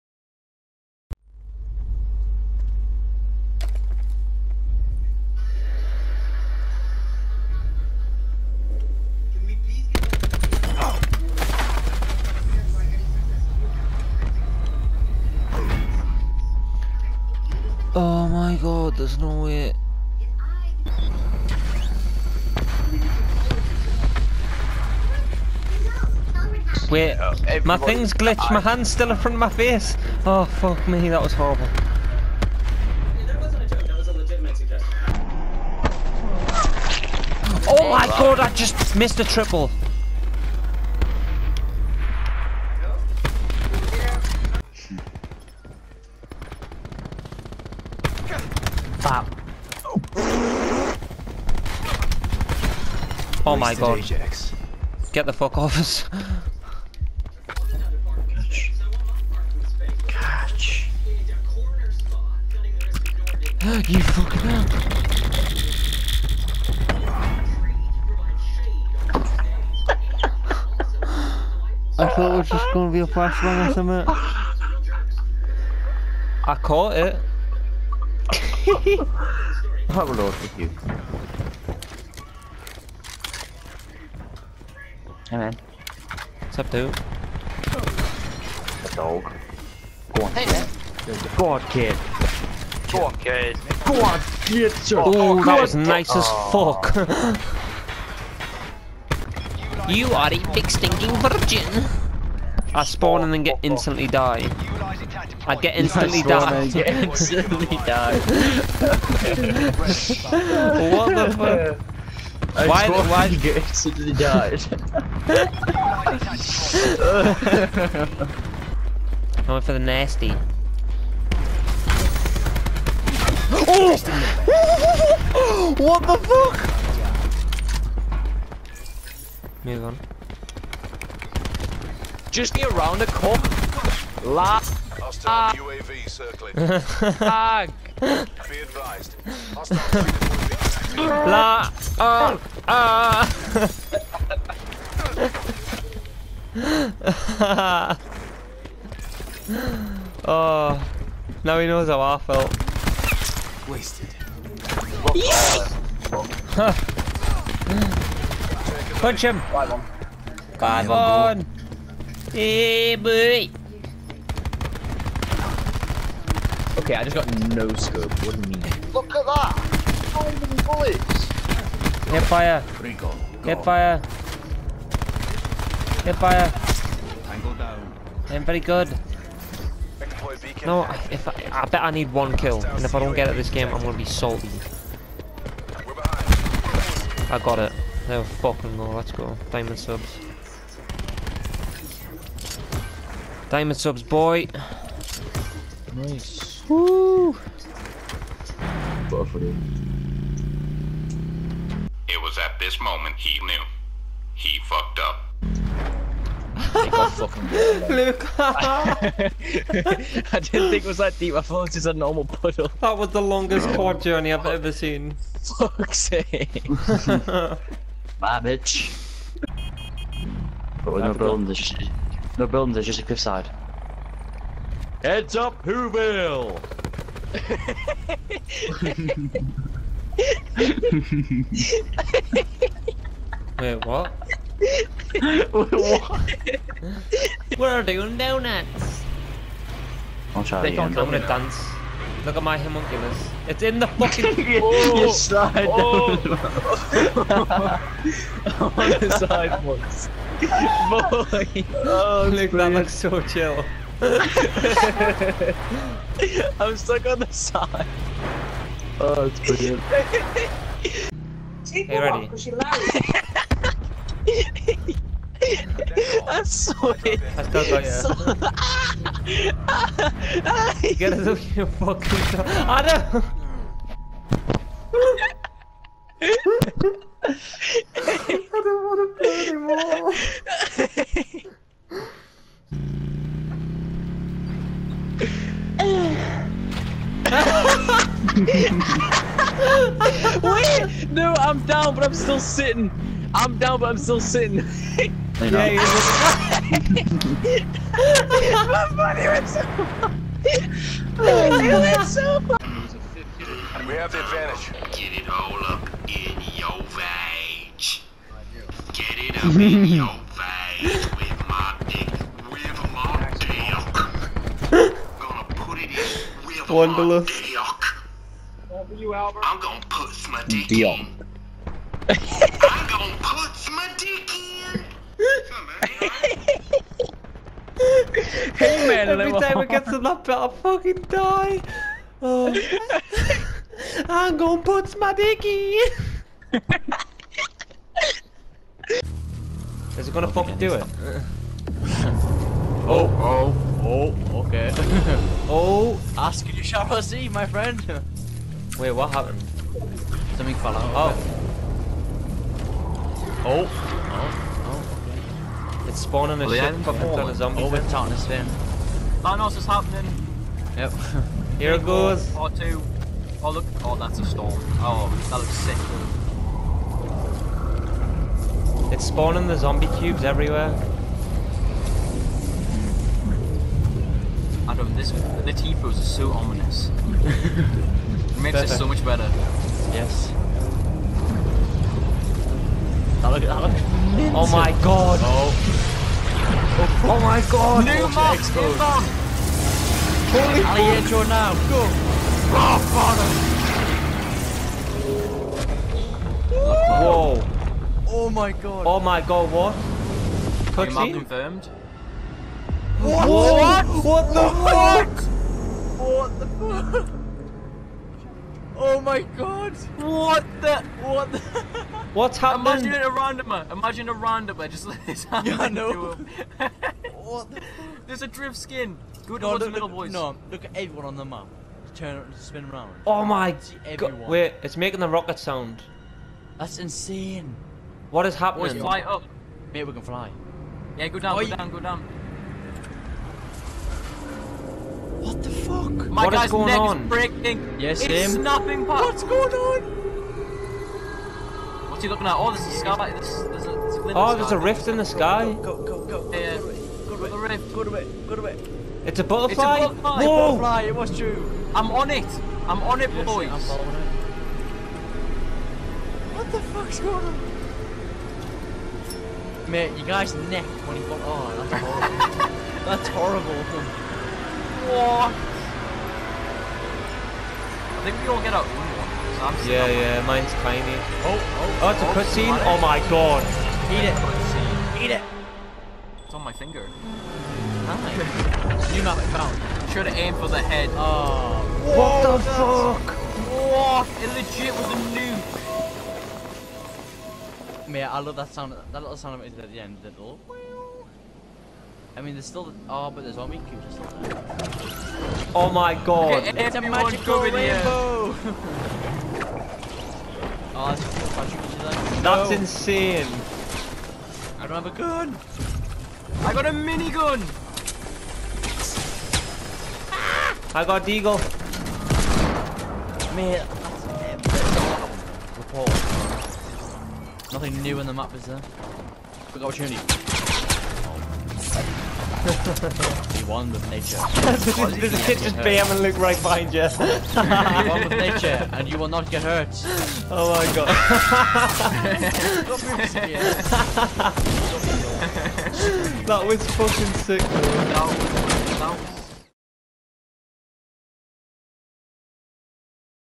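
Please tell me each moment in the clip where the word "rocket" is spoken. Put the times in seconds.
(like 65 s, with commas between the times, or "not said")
425 s.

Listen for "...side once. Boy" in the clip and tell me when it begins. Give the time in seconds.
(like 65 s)
249 s.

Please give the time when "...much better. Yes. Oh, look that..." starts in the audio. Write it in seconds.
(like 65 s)
378 s.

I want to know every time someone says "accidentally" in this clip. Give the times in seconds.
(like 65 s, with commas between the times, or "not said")
113 s.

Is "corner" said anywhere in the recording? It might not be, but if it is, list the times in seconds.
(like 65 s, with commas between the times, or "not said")
133 s.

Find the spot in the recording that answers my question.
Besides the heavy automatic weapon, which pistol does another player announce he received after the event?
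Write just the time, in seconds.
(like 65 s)
511 s.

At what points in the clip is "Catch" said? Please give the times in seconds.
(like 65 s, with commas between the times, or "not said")
56 s, 60 s.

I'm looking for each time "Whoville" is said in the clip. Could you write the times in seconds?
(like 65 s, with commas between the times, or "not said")
225 s.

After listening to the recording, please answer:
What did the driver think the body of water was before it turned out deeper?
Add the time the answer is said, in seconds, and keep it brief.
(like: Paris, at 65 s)
a normal puddle, at 211 s.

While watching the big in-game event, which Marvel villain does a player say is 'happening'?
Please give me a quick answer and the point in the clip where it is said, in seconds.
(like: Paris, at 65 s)
Thanos, at 359 s.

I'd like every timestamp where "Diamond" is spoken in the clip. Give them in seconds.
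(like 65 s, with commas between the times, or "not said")
189 s, 193 s.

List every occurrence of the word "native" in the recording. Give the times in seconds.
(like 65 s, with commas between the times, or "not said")
not said.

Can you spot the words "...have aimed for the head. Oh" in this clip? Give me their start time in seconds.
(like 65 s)
480 s.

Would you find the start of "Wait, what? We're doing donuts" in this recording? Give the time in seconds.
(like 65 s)
235 s.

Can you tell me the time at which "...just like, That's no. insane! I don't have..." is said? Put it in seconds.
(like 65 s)
501 s.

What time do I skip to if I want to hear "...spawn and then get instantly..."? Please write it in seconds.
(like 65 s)
102 s.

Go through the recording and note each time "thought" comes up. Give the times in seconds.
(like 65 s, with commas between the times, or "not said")
72 s, 211 s.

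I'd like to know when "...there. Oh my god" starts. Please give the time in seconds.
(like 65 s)
494 s.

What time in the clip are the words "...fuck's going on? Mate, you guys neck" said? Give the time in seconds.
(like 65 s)
456 s.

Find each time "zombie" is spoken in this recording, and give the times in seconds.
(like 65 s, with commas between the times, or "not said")
357 s, 369 s.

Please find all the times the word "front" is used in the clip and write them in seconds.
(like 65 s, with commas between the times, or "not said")
29 s.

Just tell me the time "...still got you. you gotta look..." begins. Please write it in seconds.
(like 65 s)
267 s.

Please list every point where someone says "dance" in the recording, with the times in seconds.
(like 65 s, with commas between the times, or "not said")
241 s.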